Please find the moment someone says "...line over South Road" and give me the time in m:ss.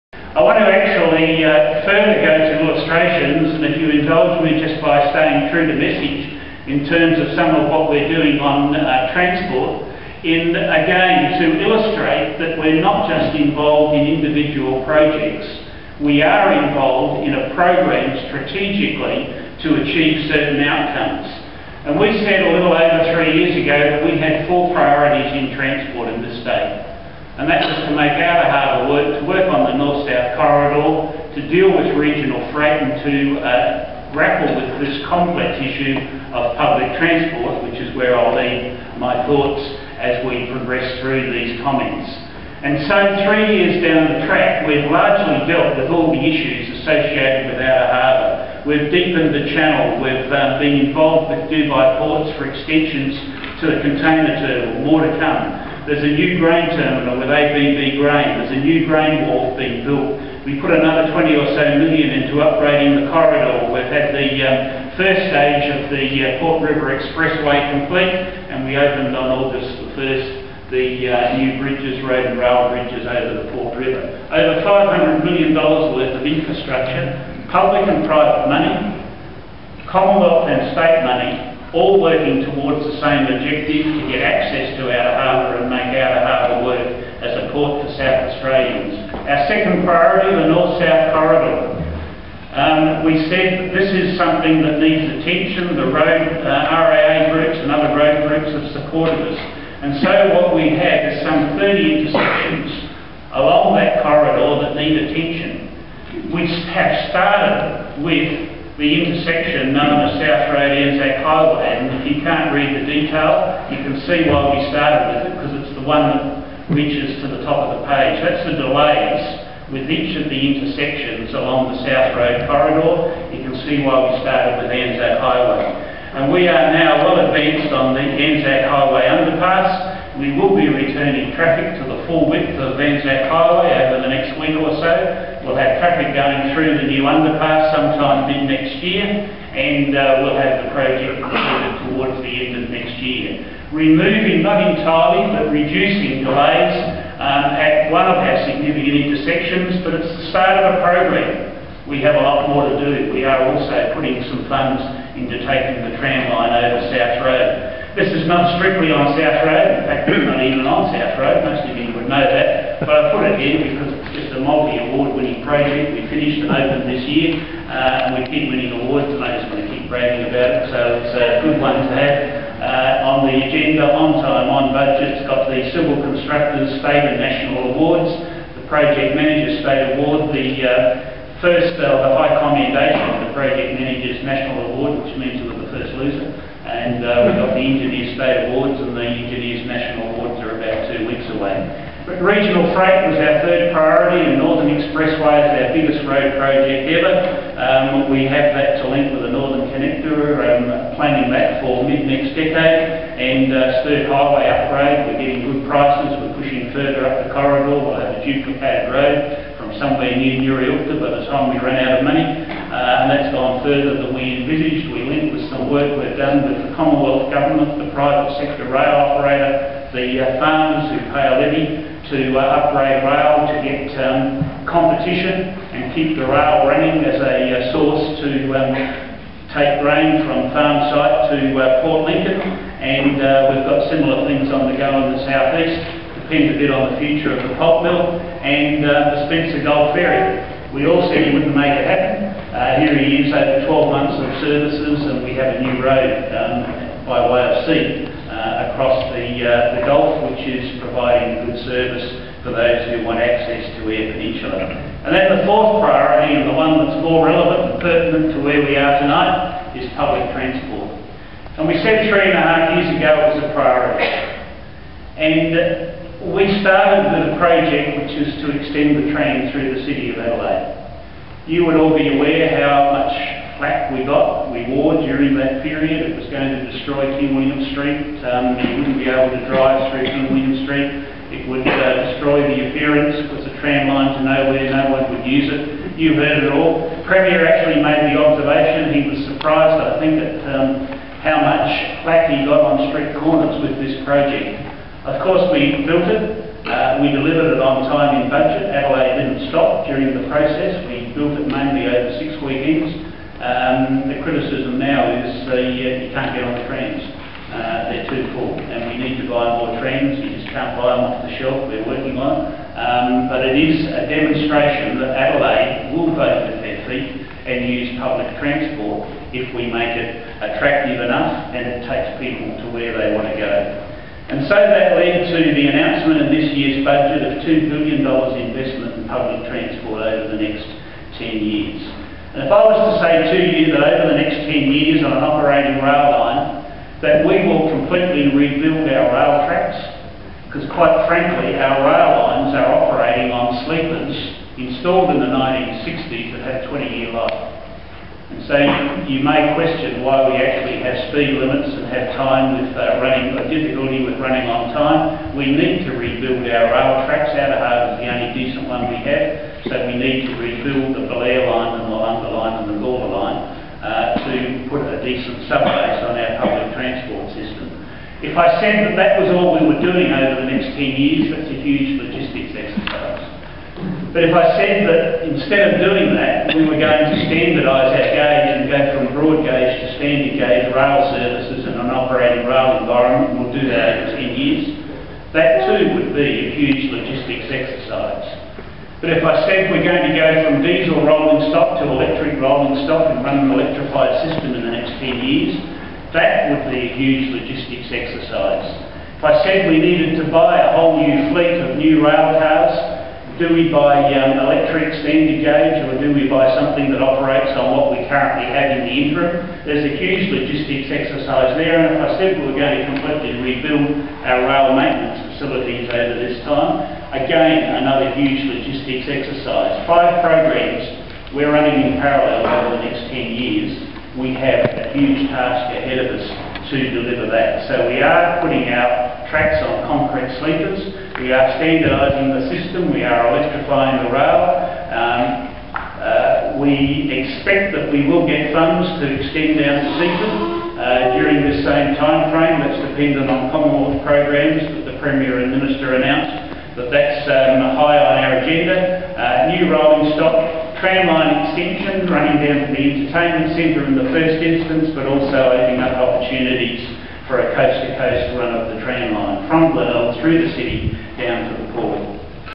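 2:36.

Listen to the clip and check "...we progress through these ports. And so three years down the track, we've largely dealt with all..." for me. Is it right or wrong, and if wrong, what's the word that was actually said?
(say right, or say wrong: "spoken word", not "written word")
wrong: "comments", not "ports".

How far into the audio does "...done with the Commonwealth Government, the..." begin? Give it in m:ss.
3:36.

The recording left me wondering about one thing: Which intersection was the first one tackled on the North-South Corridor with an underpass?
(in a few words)
South Road Anzac Highway.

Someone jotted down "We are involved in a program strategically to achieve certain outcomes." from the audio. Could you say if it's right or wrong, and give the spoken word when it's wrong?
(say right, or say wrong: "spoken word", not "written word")
right.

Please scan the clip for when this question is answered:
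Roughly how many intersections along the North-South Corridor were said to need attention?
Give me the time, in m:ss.
1:41.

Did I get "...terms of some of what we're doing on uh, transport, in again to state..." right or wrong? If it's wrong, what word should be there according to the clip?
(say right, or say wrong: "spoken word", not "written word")
wrong: "illustrate", not "state".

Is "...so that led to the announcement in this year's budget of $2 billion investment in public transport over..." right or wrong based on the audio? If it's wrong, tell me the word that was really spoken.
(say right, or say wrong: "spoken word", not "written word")
right.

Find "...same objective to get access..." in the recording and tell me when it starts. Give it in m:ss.
1:22.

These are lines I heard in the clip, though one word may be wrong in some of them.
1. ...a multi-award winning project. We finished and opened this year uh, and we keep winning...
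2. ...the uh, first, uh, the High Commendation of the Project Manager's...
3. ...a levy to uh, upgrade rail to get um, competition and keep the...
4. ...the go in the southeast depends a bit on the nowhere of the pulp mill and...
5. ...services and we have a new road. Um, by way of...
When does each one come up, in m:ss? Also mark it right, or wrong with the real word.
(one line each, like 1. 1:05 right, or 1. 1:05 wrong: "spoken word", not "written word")
1. 2:44 right
2. 3:00 right
3. 3:41 right
4. 3:54 wrong: "future", not "nowhere"
5. 4:04 right.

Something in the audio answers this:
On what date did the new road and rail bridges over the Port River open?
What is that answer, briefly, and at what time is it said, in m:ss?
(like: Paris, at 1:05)
August 1st, at 1:09.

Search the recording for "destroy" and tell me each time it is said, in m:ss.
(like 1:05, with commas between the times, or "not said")
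4:36, 4:42.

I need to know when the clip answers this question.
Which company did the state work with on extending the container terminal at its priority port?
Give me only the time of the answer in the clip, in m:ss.
0:51.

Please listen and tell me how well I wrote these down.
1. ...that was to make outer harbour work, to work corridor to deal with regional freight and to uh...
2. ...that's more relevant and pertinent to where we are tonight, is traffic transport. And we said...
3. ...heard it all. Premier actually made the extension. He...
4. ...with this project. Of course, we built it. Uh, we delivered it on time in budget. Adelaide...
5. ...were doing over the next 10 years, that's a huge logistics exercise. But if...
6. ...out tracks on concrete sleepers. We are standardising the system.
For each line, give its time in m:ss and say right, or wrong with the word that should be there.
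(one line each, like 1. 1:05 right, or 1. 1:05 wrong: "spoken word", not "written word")
1. 0:27 right
2. 4:16 wrong: "public", not "traffic"
3. 4:46 wrong: "observation", not "extension"
4. 4:53 right
5. 6:09 right
6. 7:08 right.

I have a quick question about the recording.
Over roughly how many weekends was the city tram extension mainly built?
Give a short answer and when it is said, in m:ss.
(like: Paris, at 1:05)
6, at 5:02.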